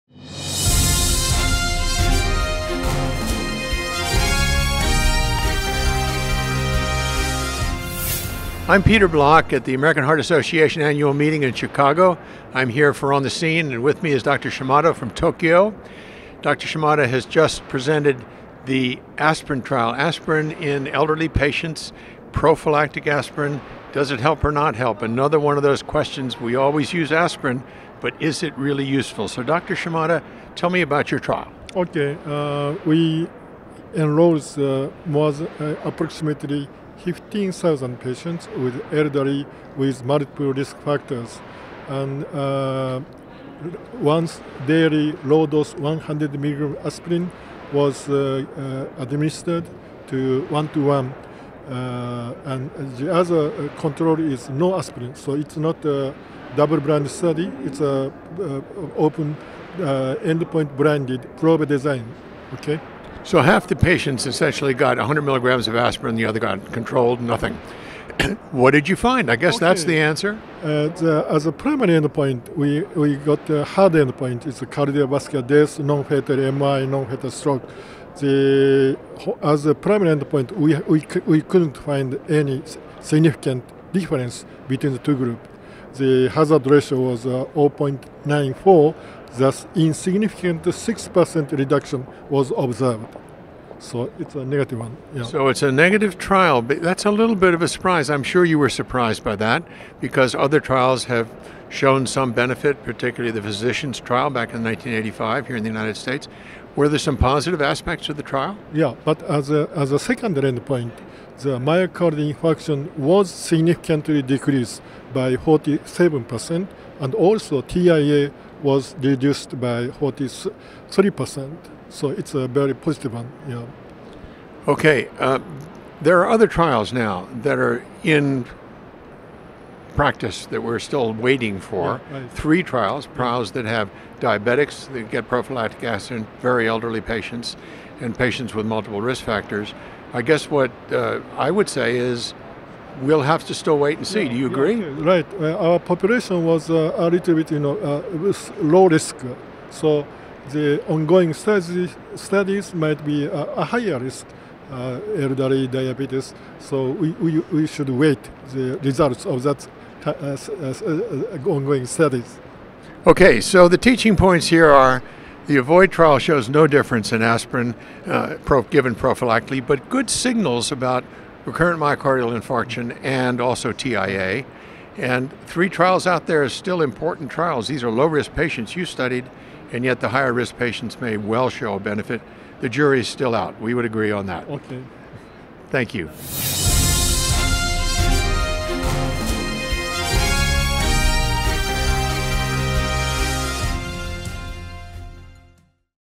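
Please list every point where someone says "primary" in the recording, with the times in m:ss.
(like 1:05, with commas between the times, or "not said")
1:11, 1:19.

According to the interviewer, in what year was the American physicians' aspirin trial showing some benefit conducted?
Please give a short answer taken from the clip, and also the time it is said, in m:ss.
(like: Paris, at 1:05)
1985, at 1:44.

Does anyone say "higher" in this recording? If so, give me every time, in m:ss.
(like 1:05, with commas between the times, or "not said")
2:33, 3:00.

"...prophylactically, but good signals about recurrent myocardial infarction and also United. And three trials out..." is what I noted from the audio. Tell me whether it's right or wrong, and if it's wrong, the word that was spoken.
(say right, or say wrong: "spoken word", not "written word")
wrong: "TIA", not "United".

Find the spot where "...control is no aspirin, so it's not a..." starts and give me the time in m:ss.
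0:53.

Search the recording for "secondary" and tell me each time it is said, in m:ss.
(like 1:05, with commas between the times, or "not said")
1:49.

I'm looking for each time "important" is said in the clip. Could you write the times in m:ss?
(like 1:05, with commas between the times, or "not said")
2:56.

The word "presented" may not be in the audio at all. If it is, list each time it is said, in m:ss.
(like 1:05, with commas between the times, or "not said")
0:17.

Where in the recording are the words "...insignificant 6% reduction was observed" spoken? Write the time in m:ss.
1:29.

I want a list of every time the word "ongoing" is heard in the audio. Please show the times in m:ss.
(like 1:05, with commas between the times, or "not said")
2:30, 2:41.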